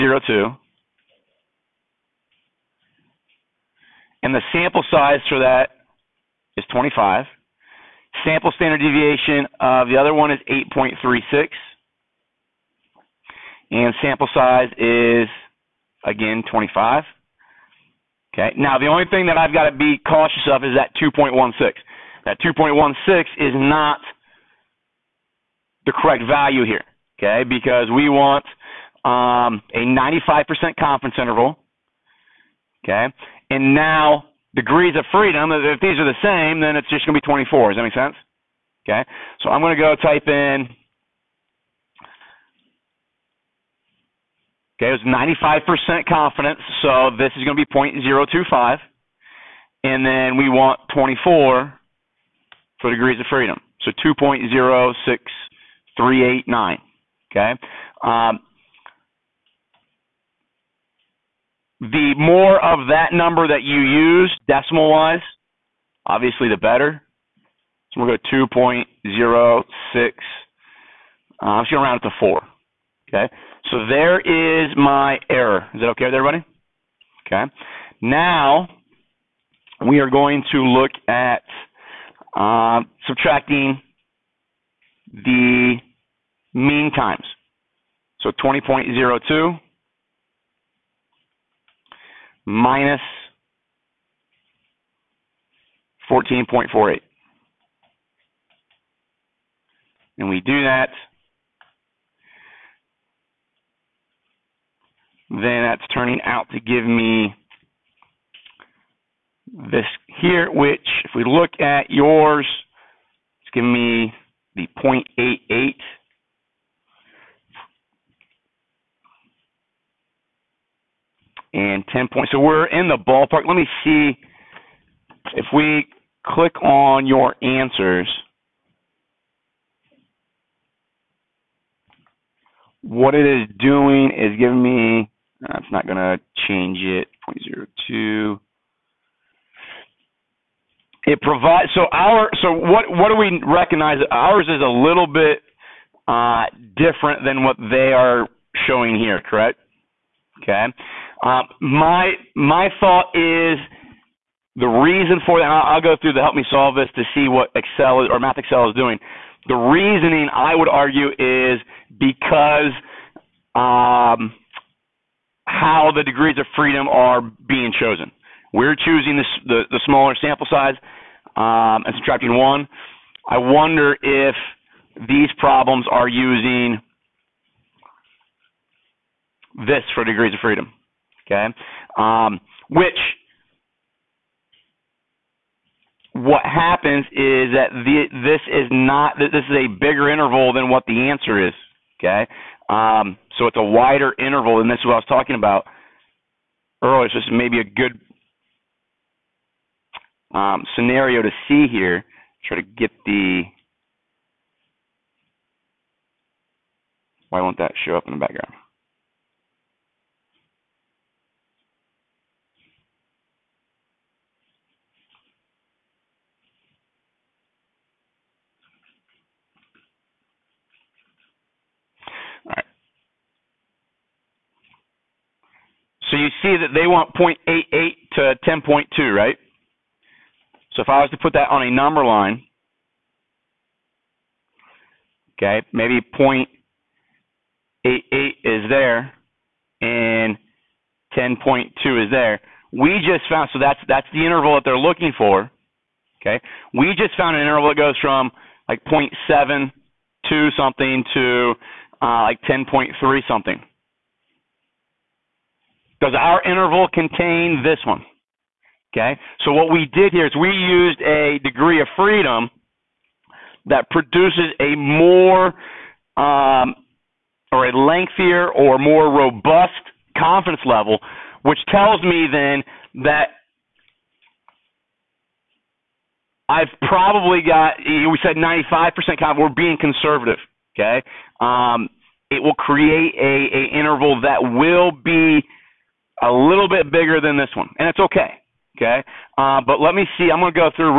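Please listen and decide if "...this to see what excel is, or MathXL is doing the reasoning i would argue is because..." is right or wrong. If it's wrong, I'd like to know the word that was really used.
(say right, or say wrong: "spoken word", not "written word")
right.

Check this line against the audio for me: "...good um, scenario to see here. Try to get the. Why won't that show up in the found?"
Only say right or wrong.
wrong.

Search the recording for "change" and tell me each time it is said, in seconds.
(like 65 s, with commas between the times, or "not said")
136 s.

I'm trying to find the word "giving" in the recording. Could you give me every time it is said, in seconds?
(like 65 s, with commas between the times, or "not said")
113 s, 134 s.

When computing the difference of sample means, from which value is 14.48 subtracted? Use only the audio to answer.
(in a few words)
20.02.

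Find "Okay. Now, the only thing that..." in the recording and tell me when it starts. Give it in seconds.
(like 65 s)
18 s.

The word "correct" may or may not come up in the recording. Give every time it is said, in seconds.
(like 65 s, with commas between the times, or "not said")
25 s, 149 s.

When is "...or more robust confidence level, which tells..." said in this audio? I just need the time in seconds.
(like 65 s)
268 s.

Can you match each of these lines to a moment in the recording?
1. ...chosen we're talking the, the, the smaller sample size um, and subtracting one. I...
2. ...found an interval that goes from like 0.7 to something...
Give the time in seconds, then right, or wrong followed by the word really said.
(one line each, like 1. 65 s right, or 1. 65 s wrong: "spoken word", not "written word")
1. 167 s wrong: "choosing", not "talking"
2. 247 s right.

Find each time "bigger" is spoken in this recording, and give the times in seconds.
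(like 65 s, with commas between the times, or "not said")
189 s, 286 s.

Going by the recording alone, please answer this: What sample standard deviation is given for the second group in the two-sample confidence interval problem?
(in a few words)
8.36.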